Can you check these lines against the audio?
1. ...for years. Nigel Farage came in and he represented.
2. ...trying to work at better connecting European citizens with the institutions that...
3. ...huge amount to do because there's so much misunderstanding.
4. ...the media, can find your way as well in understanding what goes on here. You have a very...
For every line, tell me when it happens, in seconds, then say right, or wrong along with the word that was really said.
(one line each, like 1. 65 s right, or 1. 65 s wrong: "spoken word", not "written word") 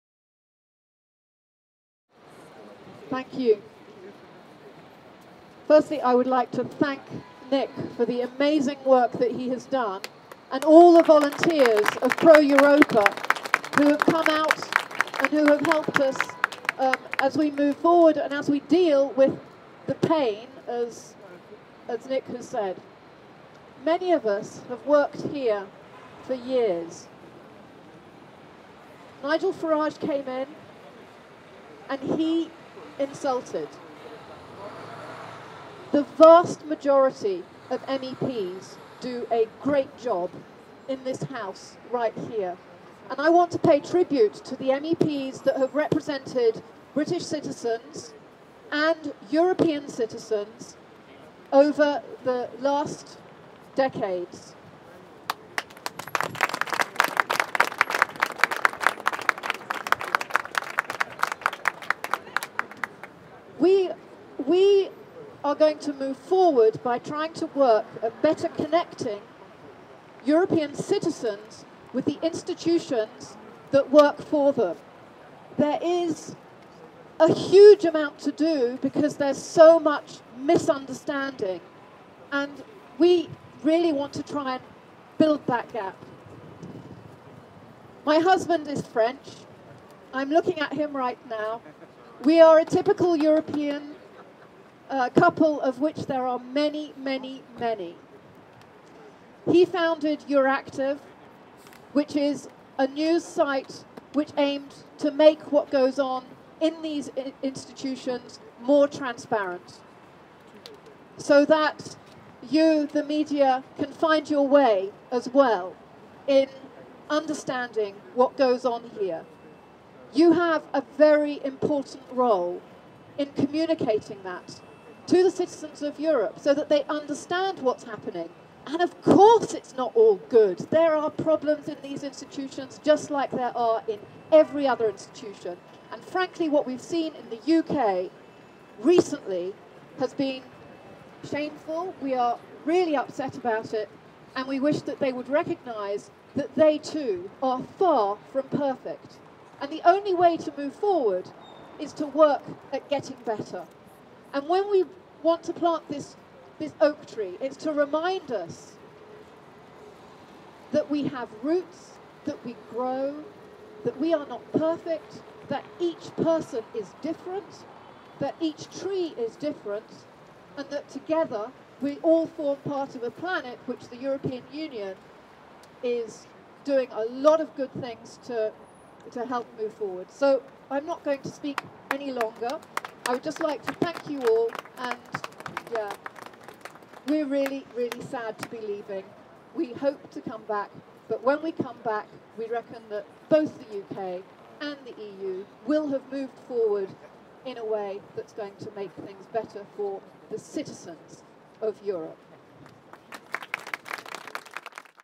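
1. 26 s wrong: "insulted", not "represented"
2. 66 s right
3. 77 s right
4. 112 s right.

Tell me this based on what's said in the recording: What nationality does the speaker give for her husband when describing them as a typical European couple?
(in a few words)
French.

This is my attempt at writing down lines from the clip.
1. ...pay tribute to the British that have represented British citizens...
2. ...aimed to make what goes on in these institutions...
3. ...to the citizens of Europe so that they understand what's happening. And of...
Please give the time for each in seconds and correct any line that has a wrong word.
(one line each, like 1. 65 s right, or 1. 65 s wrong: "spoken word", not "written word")
1. 43 s wrong: "MEPs", not "British"
2. 104 s right
3. 125 s right.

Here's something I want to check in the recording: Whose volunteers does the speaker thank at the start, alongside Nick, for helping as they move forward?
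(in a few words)
Pro Europa.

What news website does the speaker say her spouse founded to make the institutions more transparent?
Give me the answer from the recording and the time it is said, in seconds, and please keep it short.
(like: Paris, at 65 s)
Euractiv, at 100 s.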